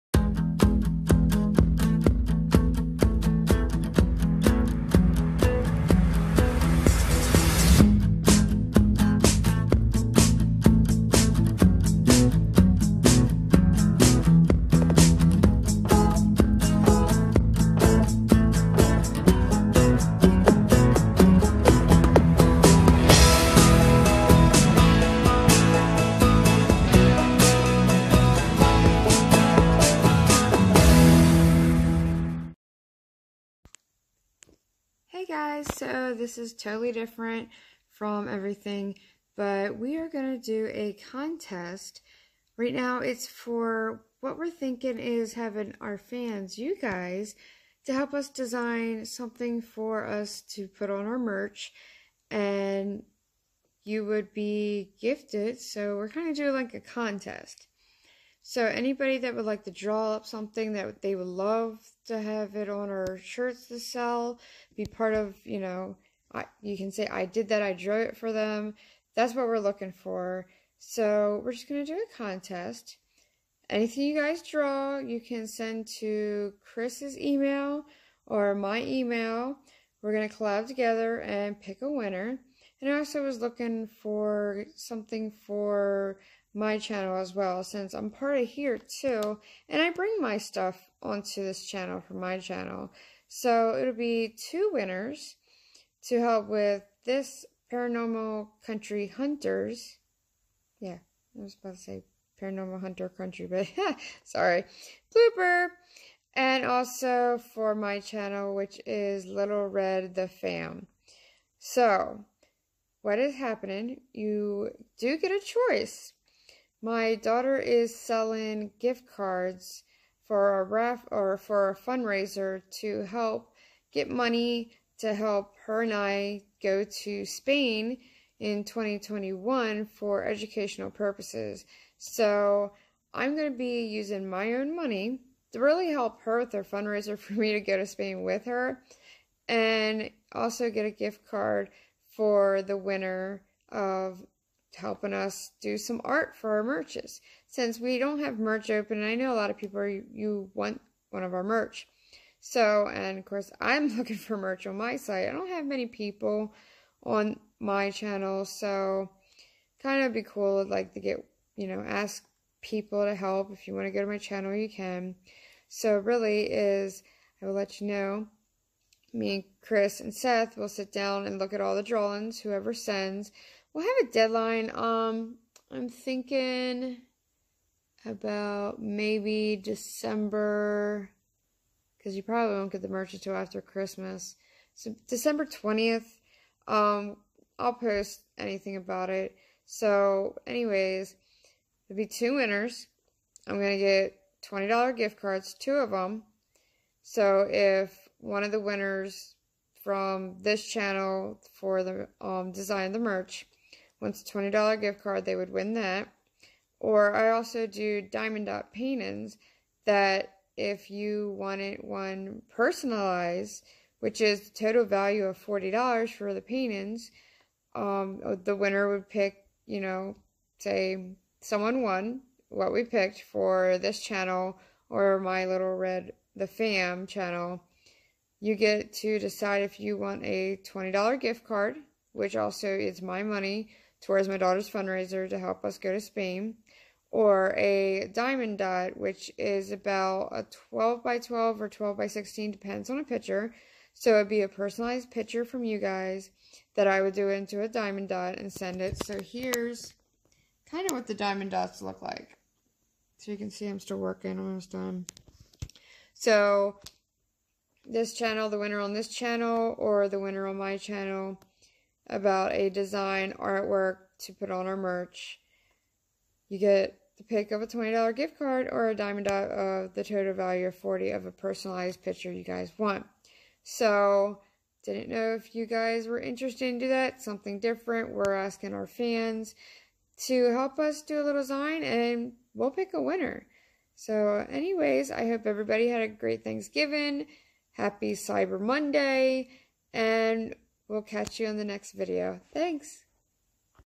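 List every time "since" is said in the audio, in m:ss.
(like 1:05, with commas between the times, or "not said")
1:27, 2:27.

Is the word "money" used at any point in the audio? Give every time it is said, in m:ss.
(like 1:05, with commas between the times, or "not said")
2:04, 2:14, 3:53.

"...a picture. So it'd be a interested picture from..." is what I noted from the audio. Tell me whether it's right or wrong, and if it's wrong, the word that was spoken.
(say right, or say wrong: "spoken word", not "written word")
wrong: "personalized", not "interested".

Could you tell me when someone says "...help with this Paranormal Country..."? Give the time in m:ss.
1:36.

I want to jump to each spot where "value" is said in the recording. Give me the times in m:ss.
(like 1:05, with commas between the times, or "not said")
3:34, 4:30.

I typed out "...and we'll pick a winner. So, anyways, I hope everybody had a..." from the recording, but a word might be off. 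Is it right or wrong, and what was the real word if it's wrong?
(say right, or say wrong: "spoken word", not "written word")
right.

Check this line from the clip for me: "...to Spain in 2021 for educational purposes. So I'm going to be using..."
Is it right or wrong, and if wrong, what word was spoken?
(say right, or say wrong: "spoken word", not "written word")
right.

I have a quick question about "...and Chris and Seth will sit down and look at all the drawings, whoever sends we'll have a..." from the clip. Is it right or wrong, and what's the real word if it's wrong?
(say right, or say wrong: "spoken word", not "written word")
right.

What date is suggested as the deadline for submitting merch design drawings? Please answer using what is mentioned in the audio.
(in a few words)
December 20th.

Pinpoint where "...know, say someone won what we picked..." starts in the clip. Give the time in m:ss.
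3:39.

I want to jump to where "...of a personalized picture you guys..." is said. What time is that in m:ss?
4:31.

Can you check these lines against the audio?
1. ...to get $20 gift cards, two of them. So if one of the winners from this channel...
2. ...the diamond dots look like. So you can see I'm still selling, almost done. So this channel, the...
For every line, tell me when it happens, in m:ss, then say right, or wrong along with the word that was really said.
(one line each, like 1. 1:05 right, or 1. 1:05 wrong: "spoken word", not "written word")
1. 3:13 right
2. 4:11 wrong: "working", not "selling".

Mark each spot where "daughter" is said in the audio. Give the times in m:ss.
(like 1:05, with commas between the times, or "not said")
1:57, 3:54.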